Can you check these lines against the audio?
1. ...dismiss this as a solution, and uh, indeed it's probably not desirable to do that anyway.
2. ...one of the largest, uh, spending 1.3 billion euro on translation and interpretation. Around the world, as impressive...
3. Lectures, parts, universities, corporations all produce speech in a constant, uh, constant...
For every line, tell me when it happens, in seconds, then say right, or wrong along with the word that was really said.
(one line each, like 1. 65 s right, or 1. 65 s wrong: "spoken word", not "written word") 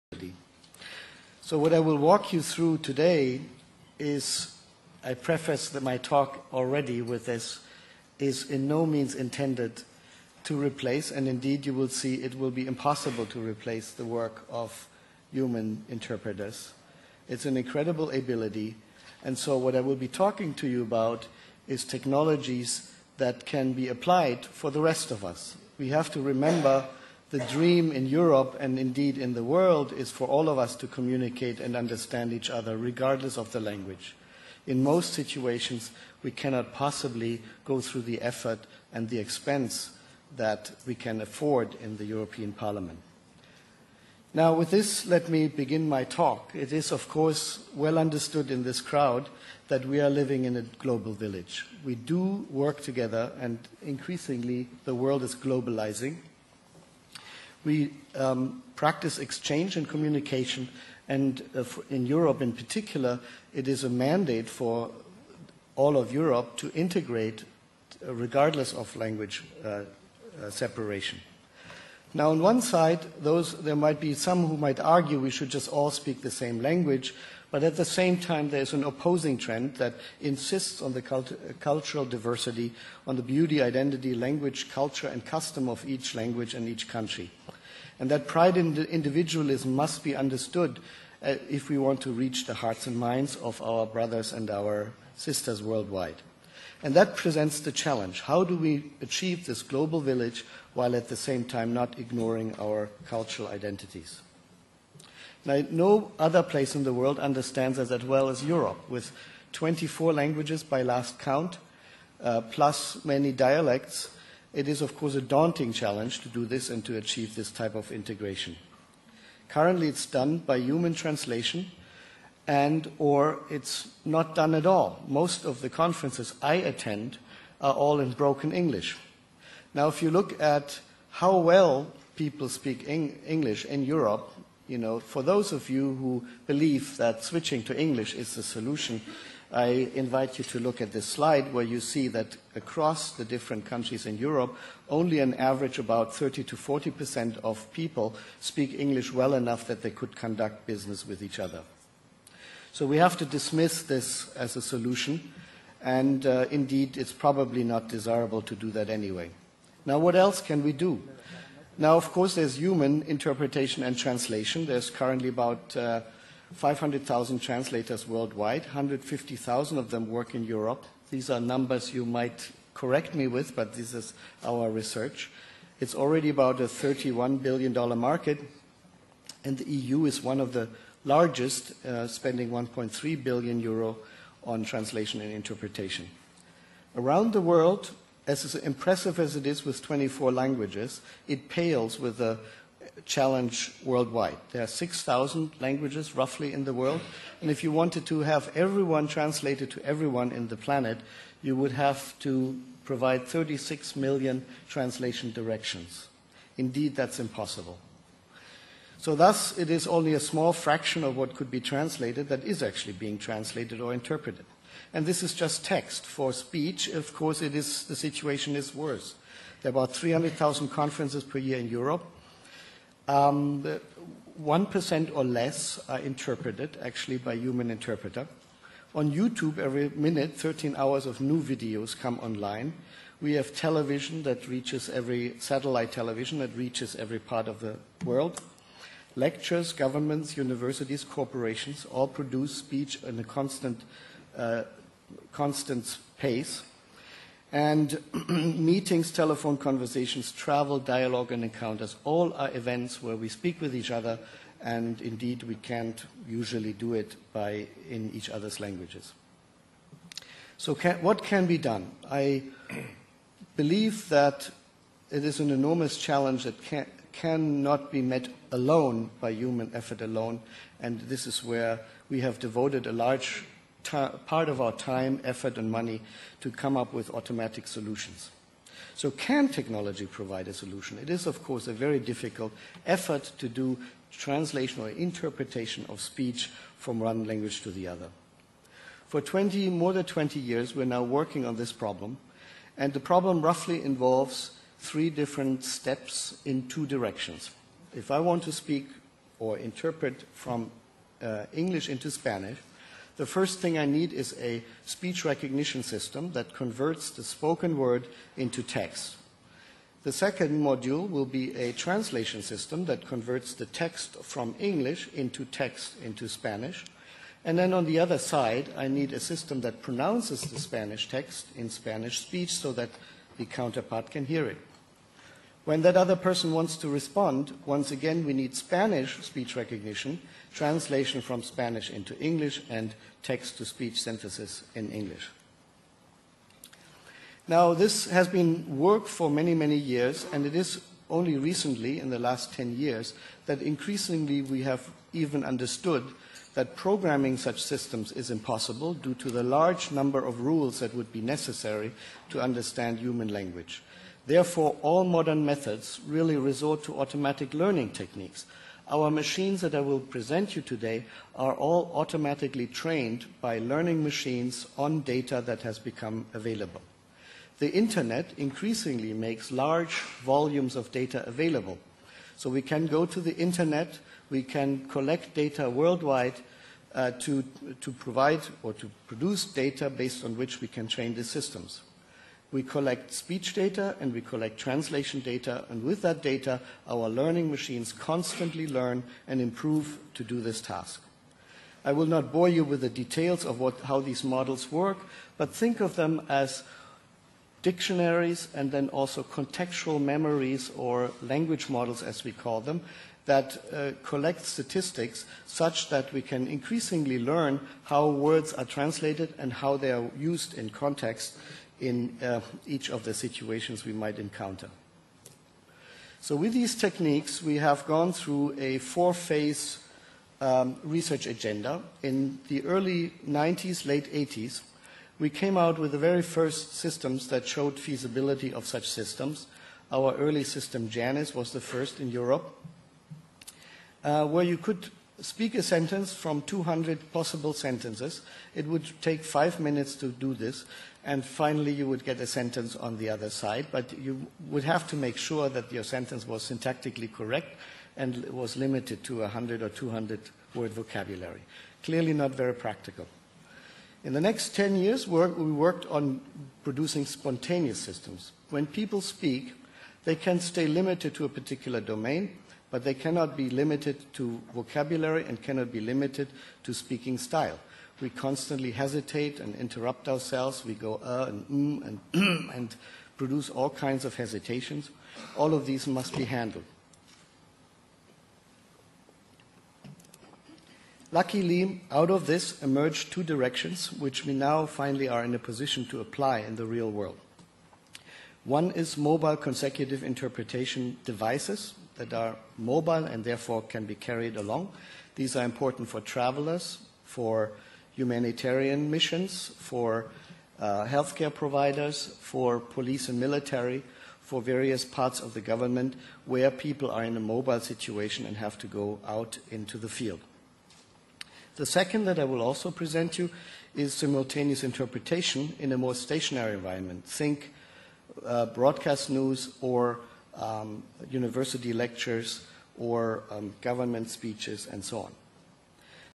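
1. 153 s right
2. 180 s right
3. 239 s wrong: "governments", not "parts".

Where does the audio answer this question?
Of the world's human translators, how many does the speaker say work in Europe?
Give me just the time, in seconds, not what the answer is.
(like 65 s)
168 s.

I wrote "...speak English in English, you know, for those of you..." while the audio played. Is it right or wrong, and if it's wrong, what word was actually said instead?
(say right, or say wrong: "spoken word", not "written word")
wrong: "Europe", not "English".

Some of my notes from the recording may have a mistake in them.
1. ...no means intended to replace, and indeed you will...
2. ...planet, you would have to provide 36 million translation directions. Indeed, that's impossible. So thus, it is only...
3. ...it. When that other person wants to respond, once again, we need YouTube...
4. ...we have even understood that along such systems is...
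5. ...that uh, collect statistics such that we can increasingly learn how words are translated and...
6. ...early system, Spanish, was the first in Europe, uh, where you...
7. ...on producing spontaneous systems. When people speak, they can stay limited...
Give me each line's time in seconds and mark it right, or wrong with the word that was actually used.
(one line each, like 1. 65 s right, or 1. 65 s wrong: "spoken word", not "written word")
1. 8 s right
2. 200 s right
3. 324 s wrong: "Spanish", not "YouTube"
4. 344 s wrong: "programming", not "along"
5. 403 s right
6. 430 s wrong: "Janus", not "Spanish"
7. 455 s right.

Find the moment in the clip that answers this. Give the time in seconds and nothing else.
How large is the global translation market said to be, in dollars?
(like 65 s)
176 s.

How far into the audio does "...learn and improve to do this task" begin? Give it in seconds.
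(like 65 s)
388 s.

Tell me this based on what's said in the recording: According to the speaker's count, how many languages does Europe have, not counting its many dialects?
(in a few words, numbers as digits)
24.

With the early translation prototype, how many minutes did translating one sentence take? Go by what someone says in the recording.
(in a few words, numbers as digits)
5 minutes.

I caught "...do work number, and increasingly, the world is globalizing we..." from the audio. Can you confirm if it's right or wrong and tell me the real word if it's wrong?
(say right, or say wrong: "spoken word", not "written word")
wrong: "together", not "number".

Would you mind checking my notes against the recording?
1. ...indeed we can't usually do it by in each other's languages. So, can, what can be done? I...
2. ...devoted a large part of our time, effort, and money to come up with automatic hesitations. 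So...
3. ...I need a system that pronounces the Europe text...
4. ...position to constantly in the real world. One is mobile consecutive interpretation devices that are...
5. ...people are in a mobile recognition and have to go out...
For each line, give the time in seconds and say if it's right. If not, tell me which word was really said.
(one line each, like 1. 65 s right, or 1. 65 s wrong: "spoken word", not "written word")
1. 255 s right
2. 272 s wrong: "solutions", not "hesitations"
3. 318 s wrong: "Spanish", not "Europe"
4. 485 s wrong: "apply", not "constantly"
5. 506 s wrong: "situation", not "recognition".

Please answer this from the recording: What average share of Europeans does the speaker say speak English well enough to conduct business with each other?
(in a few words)
30 to 40 percent.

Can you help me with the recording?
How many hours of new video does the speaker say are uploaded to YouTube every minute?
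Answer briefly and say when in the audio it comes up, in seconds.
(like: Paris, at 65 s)
13 hours, at 230 s.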